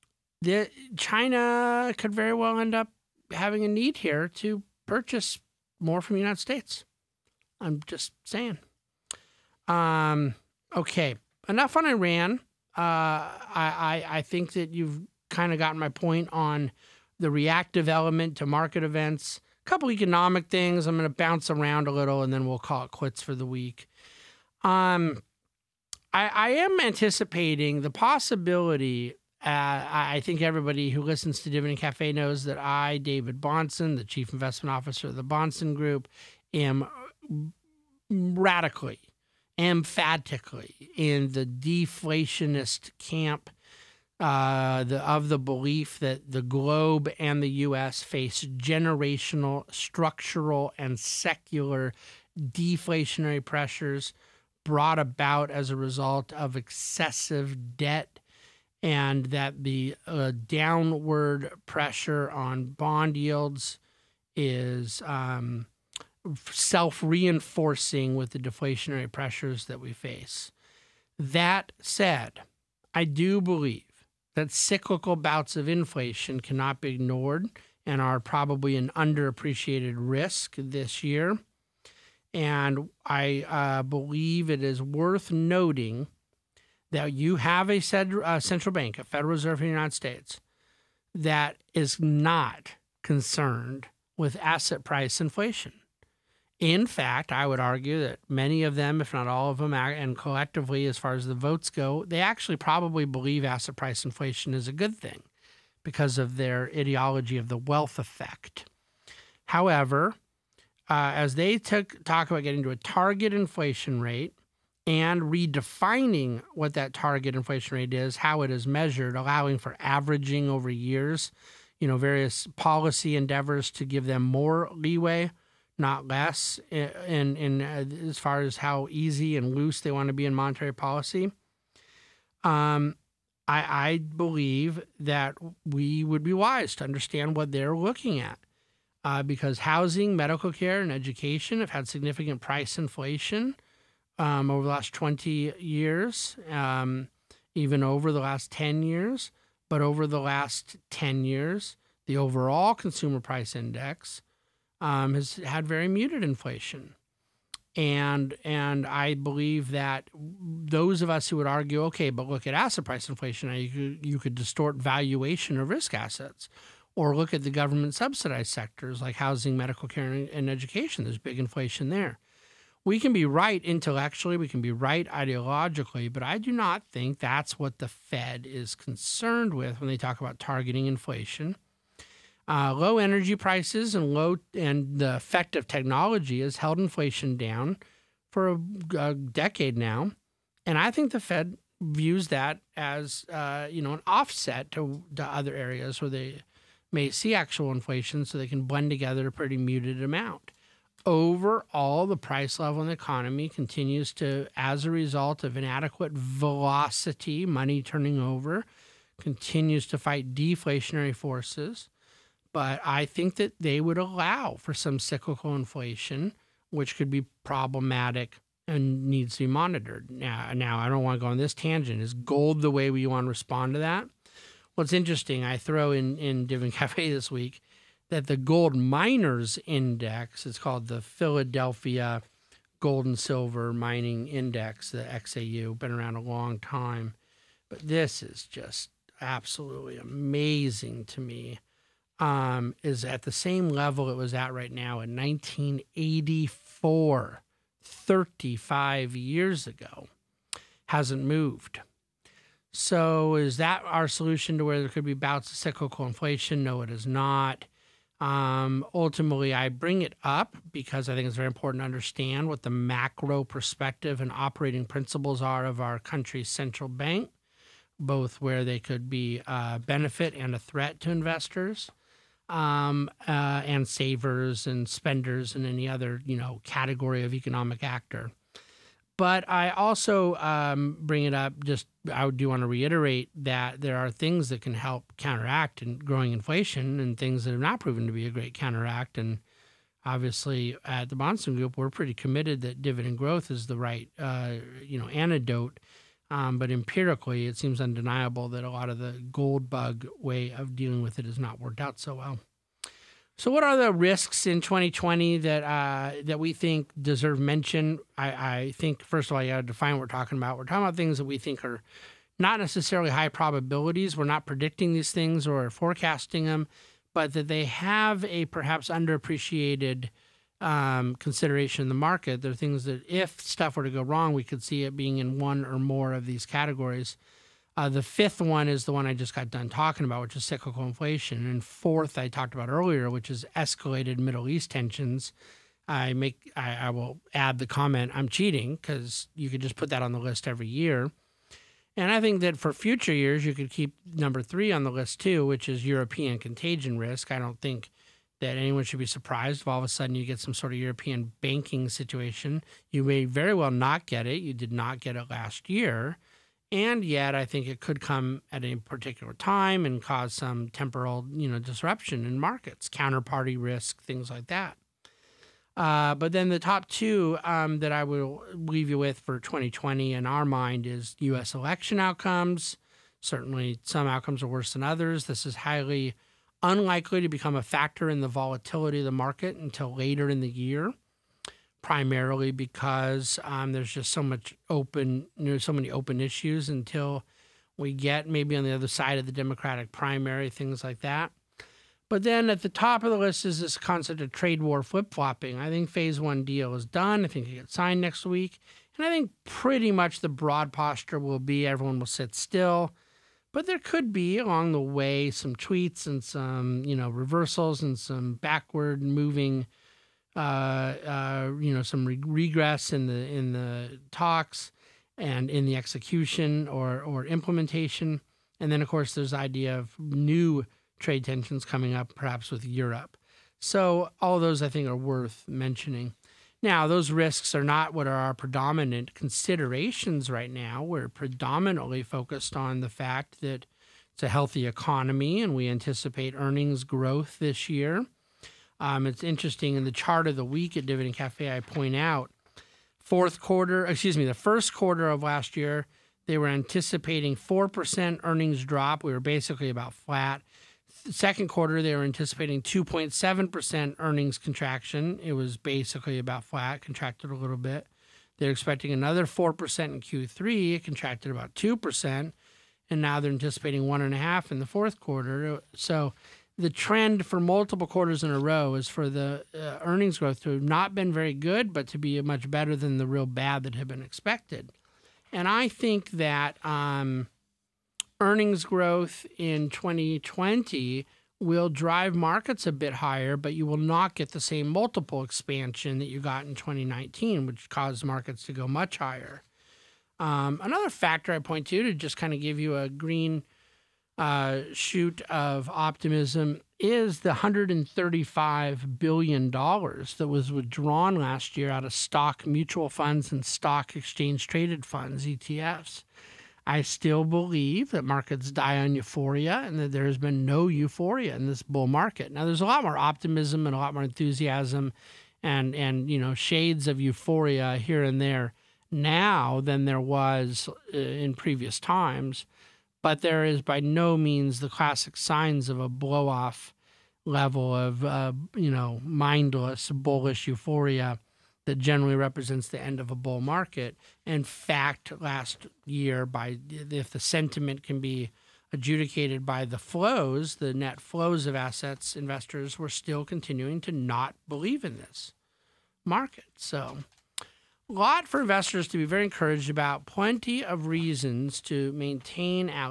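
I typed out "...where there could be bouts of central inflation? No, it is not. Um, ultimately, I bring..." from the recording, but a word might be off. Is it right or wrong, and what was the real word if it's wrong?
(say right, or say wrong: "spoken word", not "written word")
wrong: "cyclical", not "central".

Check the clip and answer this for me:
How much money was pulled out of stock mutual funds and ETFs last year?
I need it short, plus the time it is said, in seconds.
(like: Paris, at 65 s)
$135 billion, at 497 s.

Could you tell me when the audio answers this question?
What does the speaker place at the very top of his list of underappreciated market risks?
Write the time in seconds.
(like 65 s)
394 s.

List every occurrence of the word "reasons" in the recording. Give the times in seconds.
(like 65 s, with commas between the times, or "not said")
550 s.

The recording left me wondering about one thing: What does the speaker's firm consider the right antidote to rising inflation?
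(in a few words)
Dividend growth.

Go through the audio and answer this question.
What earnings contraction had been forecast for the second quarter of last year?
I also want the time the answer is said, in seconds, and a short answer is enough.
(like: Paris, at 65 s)
2.7%, at 452 s.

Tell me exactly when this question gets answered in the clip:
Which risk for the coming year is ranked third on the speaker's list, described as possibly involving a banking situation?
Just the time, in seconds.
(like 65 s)
345 s.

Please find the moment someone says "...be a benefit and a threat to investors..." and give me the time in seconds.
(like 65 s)
269 s.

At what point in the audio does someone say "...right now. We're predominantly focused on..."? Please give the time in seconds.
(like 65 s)
430 s.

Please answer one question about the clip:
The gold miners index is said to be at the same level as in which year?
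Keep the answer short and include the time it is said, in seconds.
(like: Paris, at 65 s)
1984, at 245 s.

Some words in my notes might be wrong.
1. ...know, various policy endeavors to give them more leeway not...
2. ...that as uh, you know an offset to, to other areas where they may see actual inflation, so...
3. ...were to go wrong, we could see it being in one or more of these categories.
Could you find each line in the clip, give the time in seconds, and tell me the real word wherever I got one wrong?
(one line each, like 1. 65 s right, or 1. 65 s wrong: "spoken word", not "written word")
1. 121 s right
2. 192 s right
3. 323 s right.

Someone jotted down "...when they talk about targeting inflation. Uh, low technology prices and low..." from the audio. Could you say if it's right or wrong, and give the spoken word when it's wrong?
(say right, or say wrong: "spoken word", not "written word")
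wrong: "energy", not "technology".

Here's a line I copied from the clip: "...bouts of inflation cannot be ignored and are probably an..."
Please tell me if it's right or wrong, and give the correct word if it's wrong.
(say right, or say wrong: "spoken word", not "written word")
right.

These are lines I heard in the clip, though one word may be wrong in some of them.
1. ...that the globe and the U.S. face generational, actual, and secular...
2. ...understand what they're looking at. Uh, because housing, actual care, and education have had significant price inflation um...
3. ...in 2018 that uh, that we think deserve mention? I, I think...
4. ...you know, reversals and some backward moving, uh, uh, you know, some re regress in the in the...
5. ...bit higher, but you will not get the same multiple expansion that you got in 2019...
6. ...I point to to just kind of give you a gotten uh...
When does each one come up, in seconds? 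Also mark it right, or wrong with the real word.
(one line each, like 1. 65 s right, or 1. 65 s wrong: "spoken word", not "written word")
1. 45 s wrong: "structural", not "actual"
2. 136 s wrong: "medical", not "actual"
3. 304 s wrong: "2020", not "2018"
4. 406 s right
5. 482 s right
6. 491 s wrong: "green", not "gotten".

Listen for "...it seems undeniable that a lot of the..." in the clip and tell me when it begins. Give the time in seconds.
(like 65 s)
297 s.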